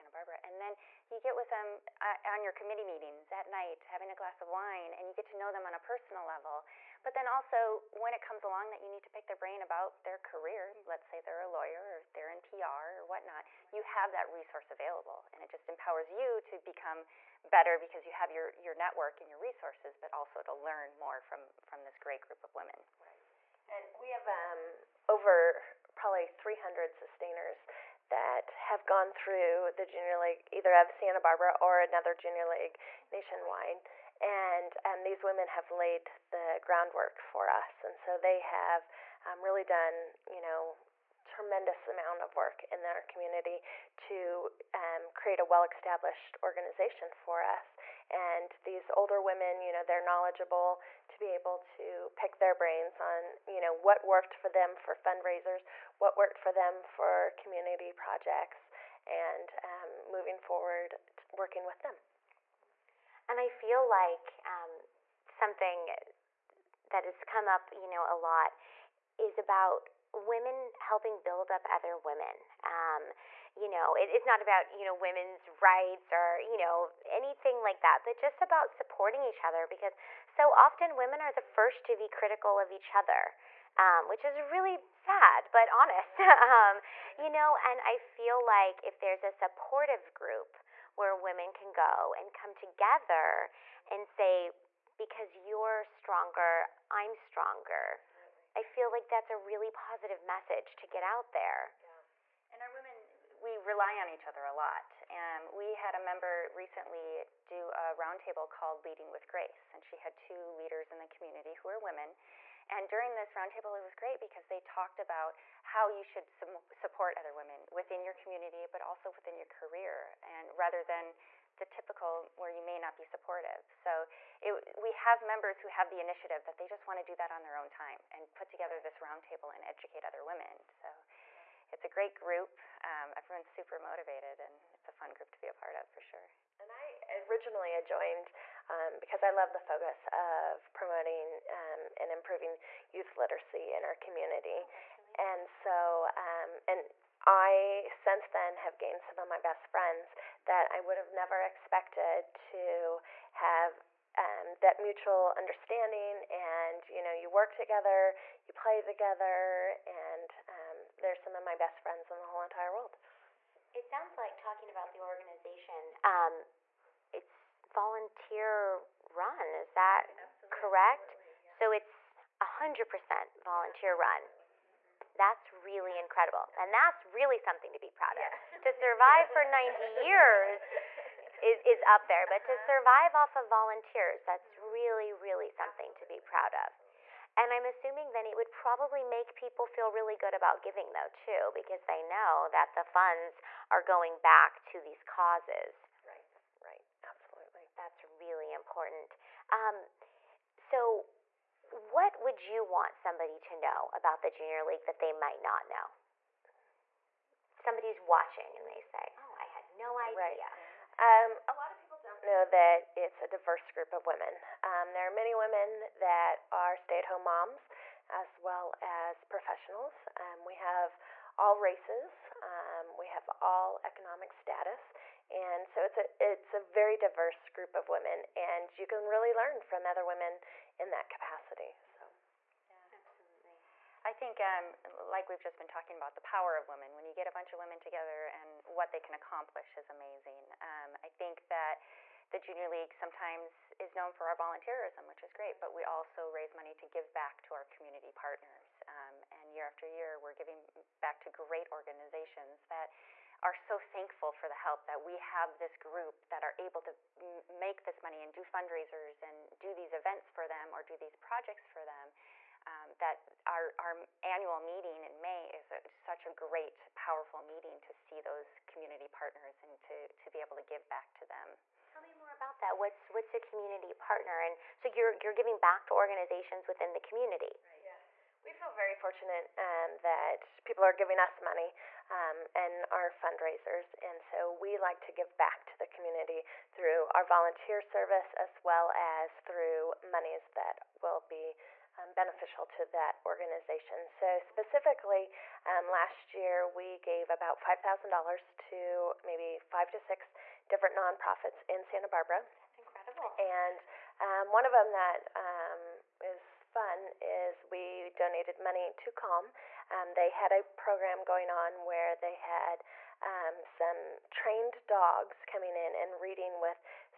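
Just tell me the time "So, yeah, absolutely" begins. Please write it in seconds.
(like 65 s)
231 s.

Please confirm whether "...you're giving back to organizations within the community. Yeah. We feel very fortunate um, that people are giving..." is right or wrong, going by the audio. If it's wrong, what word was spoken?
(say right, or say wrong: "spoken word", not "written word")
right.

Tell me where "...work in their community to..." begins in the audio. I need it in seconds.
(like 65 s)
42 s.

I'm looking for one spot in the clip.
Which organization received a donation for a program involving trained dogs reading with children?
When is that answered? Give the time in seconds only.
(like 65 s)
309 s.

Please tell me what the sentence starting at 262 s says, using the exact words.
Um, that our, our annual meeting in May is a, such a great, powerful meeting to see mm-hmm.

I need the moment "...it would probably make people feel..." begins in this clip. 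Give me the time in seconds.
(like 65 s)
188 s.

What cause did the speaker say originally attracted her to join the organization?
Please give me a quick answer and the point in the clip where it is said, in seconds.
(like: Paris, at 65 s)
youth literacy, at 142 s.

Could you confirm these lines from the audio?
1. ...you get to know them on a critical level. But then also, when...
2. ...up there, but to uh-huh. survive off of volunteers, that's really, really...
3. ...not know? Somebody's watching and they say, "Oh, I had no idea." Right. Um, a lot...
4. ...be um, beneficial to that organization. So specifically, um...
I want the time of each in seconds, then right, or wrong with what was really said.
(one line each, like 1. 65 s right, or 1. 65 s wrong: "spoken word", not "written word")
1. 5 s wrong: "personal", not "critical"
2. 181 s right
3. 205 s right
4. 291 s right.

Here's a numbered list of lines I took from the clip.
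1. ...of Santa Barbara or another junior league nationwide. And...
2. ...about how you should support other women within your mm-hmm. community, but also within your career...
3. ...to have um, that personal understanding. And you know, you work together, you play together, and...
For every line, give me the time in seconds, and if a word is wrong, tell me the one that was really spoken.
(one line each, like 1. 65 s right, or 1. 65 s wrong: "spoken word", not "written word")
1. 30 s right
2. 115 s right
3. 152 s wrong: "mutual", not "personal".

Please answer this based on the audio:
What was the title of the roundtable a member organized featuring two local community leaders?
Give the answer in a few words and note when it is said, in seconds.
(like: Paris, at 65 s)
Leading with Grace, at 108 s.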